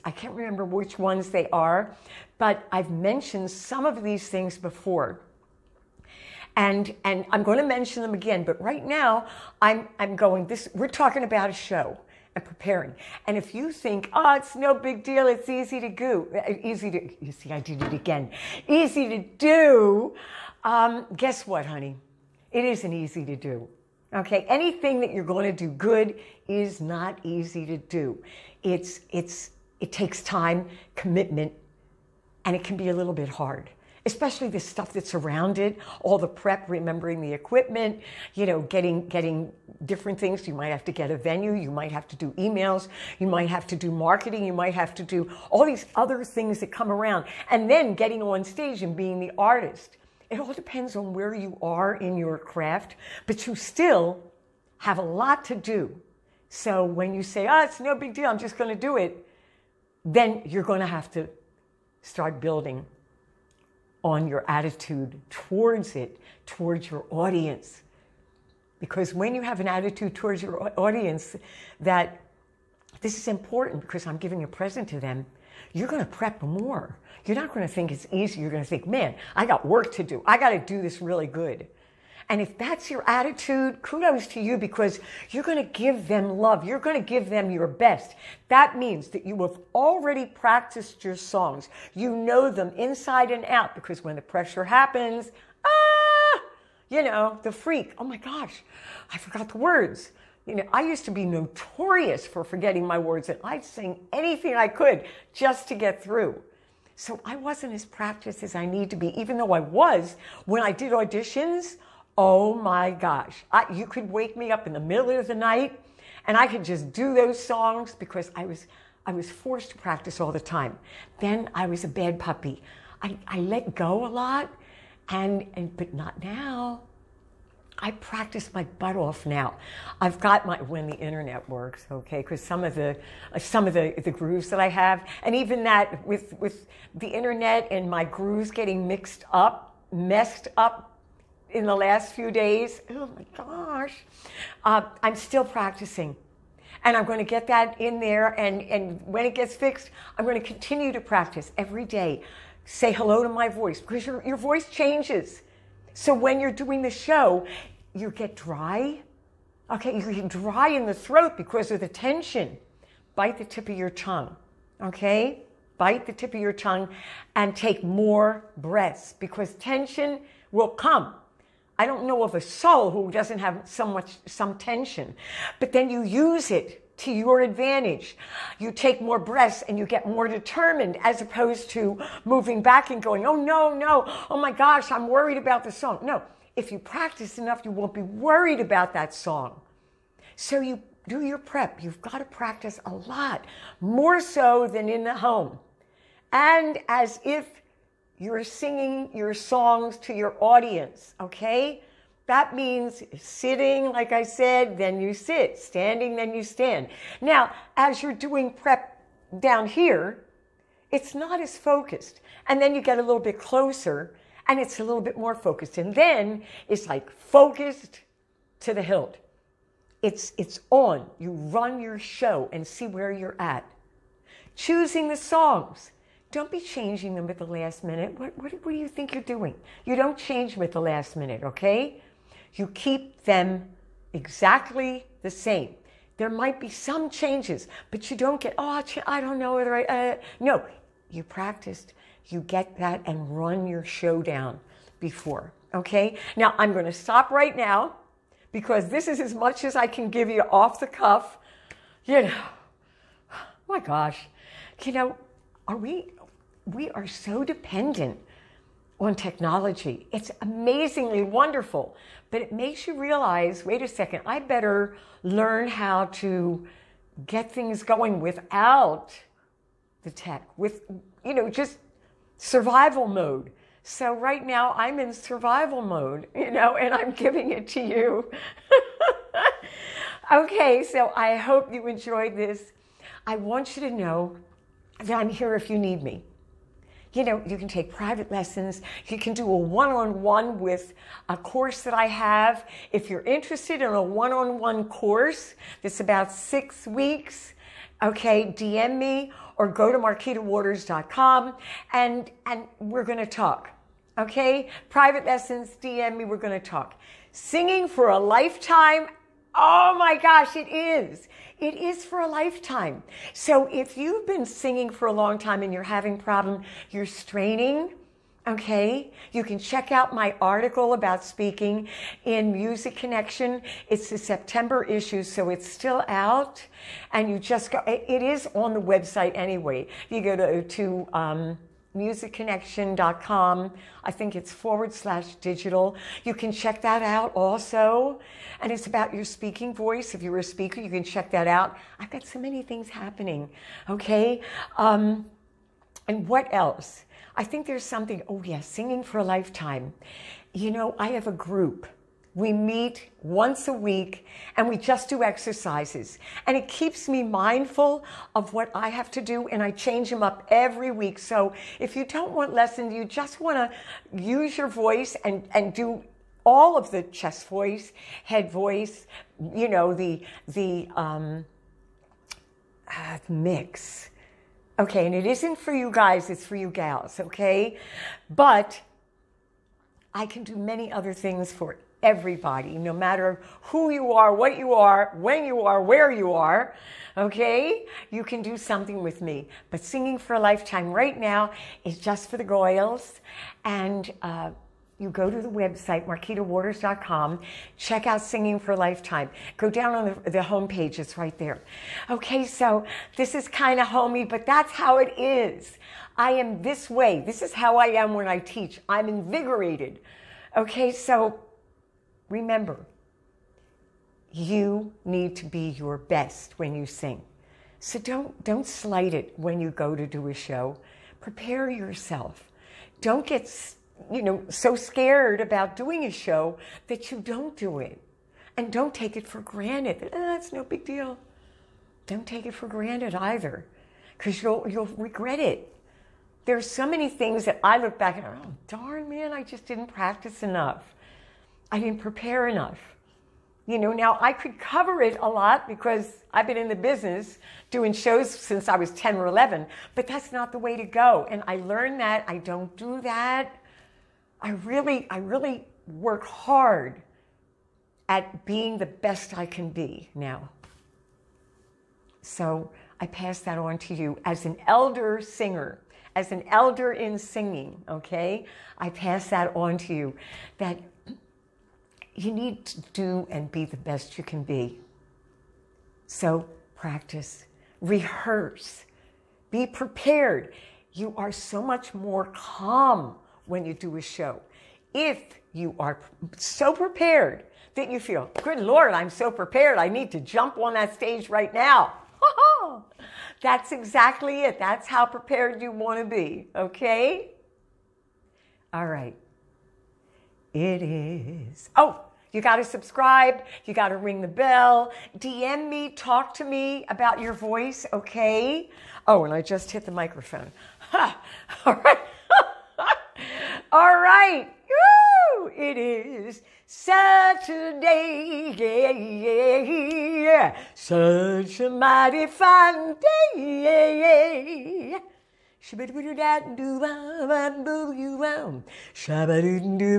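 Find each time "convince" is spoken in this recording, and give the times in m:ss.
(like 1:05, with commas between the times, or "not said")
not said.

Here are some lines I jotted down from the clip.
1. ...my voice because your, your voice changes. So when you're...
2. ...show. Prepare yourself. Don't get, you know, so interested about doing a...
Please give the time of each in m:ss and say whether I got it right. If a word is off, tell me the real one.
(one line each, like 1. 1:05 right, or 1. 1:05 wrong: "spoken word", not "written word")
1. 2:33 right
2. 7:00 wrong: "scared", not "interested".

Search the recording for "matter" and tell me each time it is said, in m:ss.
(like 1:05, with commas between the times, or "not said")
6:22.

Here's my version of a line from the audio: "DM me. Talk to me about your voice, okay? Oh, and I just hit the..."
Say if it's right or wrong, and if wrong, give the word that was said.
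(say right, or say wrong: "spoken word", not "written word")
right.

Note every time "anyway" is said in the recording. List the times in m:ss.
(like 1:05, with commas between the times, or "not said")
5:29.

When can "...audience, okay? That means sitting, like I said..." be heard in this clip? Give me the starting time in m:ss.
3:20.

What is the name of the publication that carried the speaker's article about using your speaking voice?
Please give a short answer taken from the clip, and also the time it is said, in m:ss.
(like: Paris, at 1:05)
Music Connection, at 5:22.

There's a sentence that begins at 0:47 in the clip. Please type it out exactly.
And then getting on stage and being the artist.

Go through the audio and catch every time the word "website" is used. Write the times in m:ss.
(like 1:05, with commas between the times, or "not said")
5:28, 6:35.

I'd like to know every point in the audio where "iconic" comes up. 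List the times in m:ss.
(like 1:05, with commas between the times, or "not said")
not said.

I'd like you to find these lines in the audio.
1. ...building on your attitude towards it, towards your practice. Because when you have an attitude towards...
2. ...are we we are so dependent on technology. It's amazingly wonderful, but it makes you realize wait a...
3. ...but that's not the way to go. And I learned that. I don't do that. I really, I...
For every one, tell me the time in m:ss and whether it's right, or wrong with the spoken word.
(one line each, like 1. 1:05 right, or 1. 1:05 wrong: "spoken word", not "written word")
1. 1:02 wrong: "audience", not "practice"
2. 4:15 right
3. 7:29 right.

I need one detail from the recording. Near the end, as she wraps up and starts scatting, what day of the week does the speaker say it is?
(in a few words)
Saturday.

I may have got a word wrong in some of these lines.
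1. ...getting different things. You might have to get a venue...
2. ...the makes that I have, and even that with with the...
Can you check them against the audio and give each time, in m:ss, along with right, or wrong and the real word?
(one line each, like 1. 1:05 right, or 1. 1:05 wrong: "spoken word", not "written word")
1. 0:39 right
2. 2:14 wrong: "grooves", not "makes".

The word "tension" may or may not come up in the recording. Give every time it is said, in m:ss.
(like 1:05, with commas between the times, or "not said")
2:41, 2:49, 2:54.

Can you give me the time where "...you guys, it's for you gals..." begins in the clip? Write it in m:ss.
6:15.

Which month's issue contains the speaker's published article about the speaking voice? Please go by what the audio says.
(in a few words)
September.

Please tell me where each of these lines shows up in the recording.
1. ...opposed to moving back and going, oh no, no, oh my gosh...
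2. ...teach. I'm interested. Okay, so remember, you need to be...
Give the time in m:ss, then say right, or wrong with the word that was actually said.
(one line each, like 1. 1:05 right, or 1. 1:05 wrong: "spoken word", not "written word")
1. 3:01 right
2. 6:48 wrong: "invigorated", not "interested".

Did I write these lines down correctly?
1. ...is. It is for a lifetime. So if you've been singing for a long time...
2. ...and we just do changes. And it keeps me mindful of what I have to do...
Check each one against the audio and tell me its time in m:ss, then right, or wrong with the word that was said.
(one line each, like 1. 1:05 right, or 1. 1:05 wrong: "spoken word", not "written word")
1. 5:10 right
2. 5:54 wrong: "exercises", not "changes".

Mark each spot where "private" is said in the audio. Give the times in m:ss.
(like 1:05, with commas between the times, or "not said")
4:47, 5:04.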